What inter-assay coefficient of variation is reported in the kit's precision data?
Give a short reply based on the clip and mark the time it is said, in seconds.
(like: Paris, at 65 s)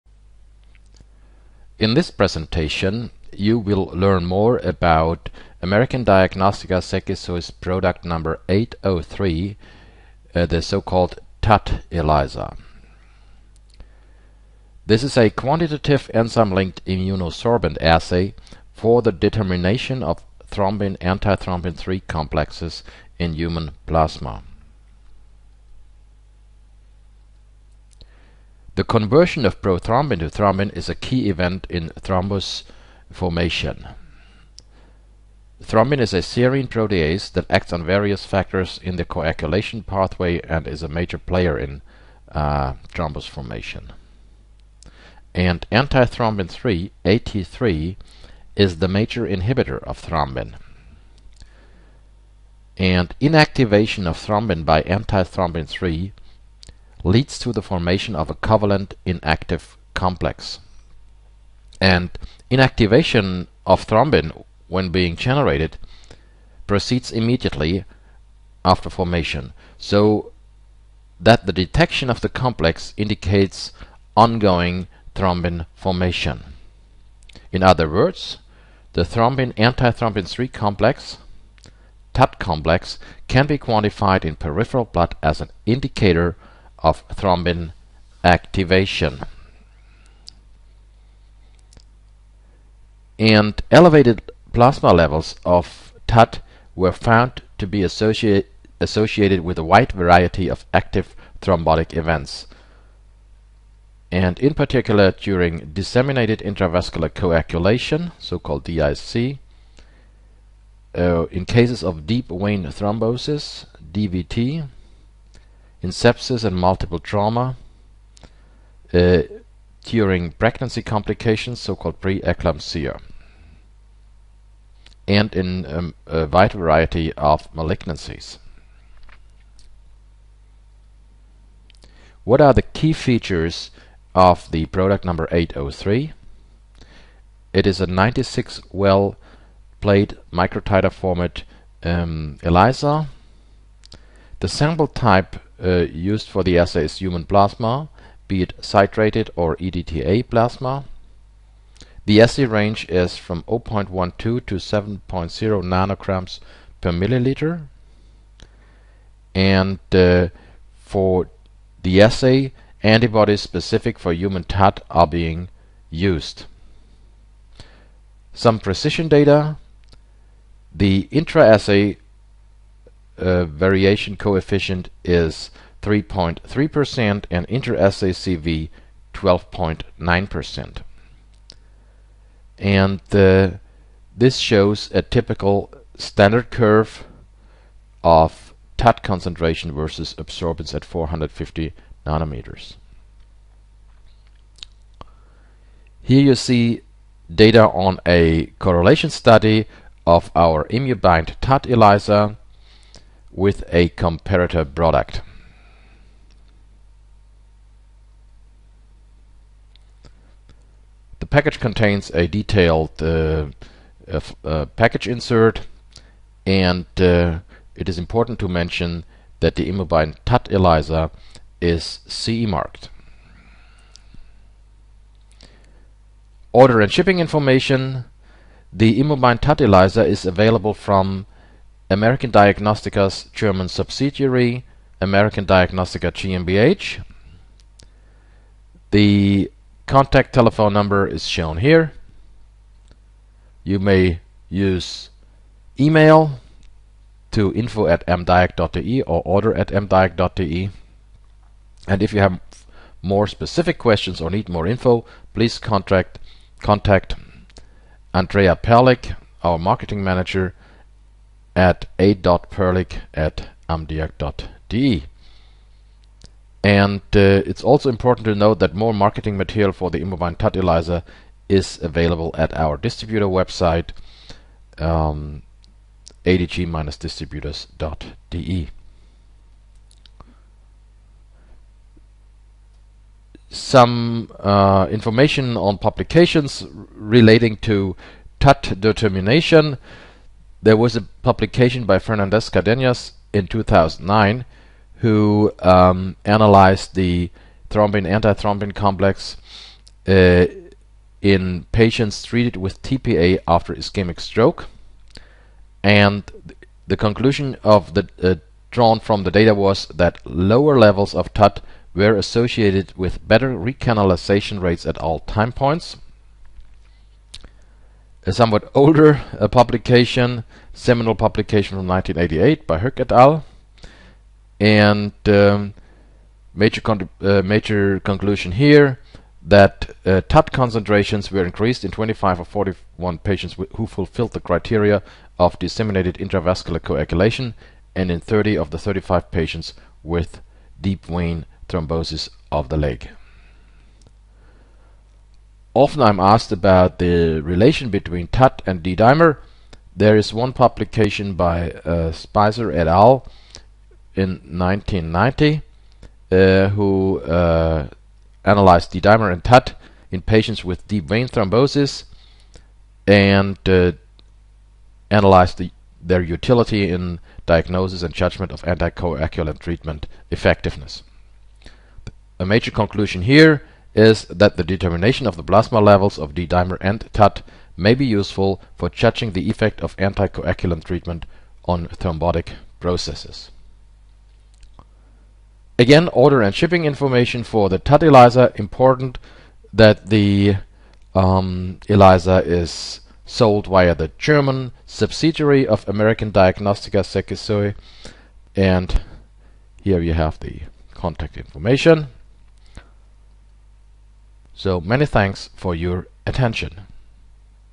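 12.9%, at 179 s.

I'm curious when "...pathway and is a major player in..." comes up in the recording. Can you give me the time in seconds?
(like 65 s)
39 s.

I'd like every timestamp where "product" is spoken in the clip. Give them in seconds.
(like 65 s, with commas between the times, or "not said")
7 s, 134 s, 204 s.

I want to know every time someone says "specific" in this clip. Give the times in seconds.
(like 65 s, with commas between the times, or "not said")
163 s, 253 s.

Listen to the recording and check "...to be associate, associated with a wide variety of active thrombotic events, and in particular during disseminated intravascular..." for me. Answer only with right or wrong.
right.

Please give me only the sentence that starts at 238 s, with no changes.
The contact telephone number is shown here.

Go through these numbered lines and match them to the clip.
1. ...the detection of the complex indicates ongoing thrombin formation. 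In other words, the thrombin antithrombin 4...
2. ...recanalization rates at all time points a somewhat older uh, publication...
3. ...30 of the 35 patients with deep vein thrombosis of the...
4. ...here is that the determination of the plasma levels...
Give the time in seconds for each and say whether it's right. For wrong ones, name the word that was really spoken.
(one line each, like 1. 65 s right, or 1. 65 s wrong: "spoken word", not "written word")
1. 71 s wrong: "3", not "4"
2. 313 s right
3. 338 s right
4. 373 s right.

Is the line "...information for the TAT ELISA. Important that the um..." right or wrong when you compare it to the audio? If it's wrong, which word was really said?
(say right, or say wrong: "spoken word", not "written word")
right.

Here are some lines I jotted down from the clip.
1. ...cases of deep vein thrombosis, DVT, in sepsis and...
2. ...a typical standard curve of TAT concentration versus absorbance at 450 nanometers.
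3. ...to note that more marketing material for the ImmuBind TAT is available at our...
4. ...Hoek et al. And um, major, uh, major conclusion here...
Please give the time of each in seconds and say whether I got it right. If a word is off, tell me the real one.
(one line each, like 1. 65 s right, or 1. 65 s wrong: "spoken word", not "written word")
1. 111 s right
2. 184 s right
3. 268 s right
4. 322 s right.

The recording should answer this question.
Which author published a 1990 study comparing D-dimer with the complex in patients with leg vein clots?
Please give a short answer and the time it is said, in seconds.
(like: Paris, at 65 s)
Speiser, at 352 s.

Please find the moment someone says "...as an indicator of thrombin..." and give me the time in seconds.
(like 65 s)
85 s.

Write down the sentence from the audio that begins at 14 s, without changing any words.
This is a quantitative enzyme-linked immunosorbent assay for the determination of thrombin antithrombin 3 complexes in human plasma.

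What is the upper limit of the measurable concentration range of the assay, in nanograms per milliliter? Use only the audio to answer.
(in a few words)
7.0.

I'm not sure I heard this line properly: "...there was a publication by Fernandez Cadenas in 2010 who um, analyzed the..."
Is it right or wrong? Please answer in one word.
wrong.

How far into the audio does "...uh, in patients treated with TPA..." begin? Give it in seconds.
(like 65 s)
300 s.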